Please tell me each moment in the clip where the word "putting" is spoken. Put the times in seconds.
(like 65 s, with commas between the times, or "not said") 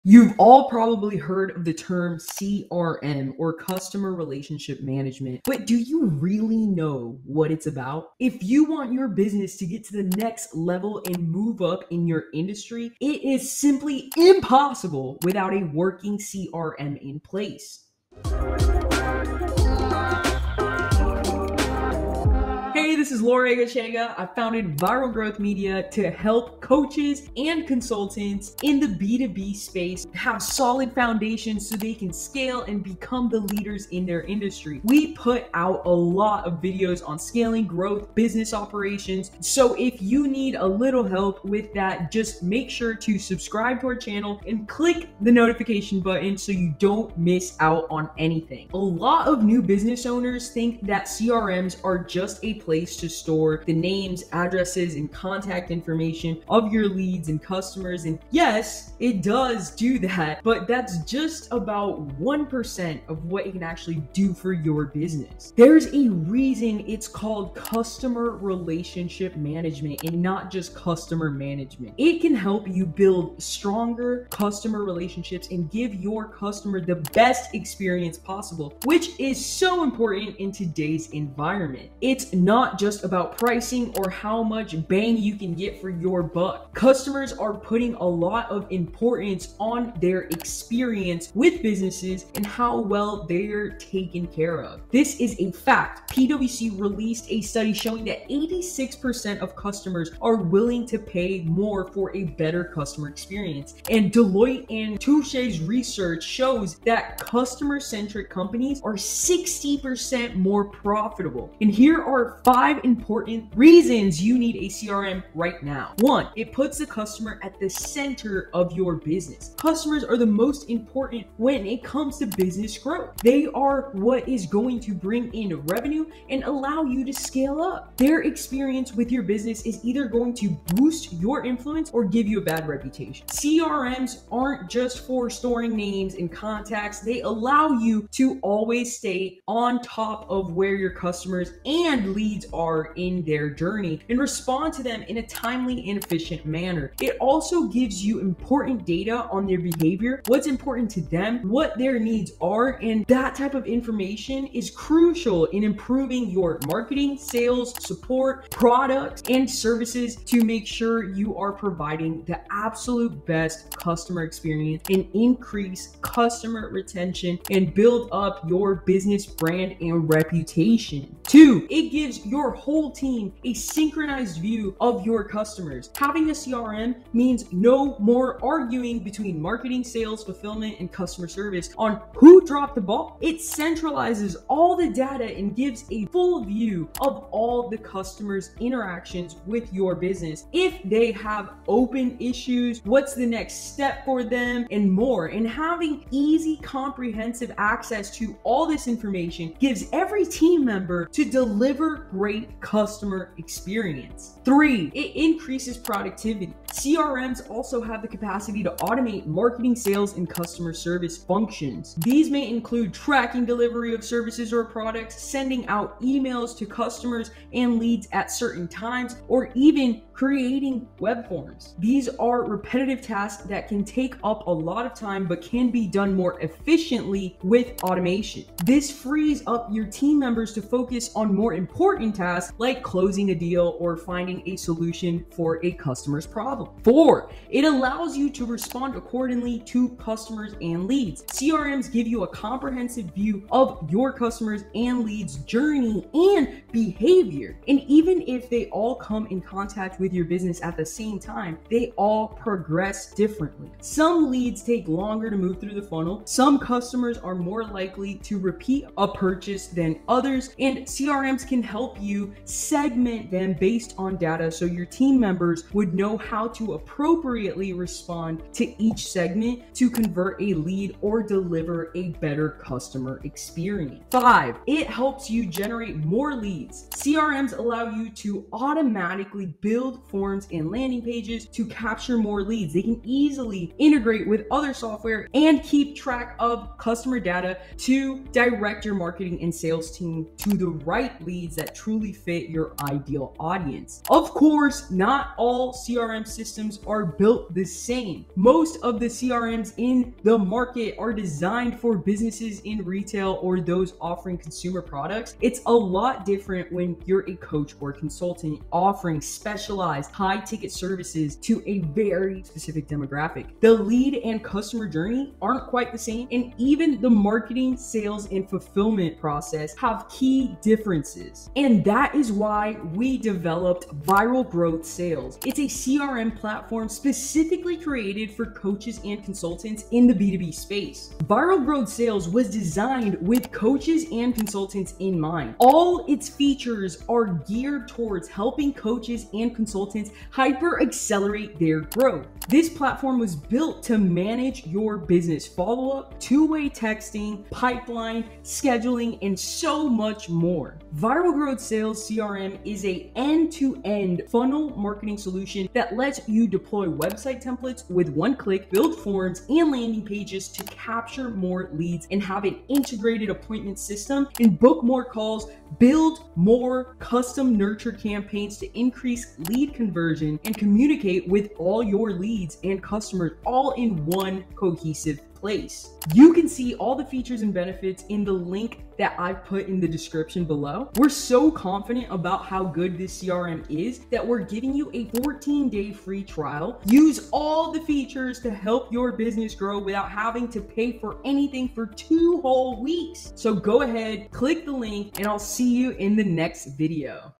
87 s.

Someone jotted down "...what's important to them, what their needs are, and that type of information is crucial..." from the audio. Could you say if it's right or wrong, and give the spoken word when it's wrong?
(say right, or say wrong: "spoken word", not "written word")
right.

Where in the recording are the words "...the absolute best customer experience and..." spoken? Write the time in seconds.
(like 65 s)
162 s.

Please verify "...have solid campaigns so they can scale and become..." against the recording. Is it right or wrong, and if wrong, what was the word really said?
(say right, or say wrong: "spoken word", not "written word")
wrong: "foundations", not "campaigns".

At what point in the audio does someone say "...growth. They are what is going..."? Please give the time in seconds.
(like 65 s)
122 s.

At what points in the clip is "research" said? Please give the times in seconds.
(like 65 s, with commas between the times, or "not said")
105 s.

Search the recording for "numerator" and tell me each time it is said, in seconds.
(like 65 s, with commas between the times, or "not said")
not said.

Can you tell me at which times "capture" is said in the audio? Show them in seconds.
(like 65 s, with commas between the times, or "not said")
281 s, 360 s.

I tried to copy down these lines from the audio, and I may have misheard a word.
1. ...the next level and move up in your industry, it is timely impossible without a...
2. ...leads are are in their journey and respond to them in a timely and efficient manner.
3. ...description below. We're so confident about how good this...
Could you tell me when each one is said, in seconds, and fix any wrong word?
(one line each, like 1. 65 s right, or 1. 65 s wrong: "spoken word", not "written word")
1. 10 s wrong: "simply", not "timely"
2. 142 s right
3. 379 s right.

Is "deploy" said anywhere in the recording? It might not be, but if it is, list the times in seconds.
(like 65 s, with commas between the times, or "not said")
356 s.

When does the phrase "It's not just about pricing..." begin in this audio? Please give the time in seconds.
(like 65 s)
82 s.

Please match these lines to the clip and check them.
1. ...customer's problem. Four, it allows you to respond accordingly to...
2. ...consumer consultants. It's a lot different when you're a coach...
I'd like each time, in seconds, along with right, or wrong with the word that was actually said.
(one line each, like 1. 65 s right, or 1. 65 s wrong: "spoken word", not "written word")
1. 235 s right
2. 304 s wrong: "products", not "consultants".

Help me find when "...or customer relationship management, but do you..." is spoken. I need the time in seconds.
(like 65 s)
3 s.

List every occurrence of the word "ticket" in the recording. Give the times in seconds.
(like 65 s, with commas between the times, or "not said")
310 s.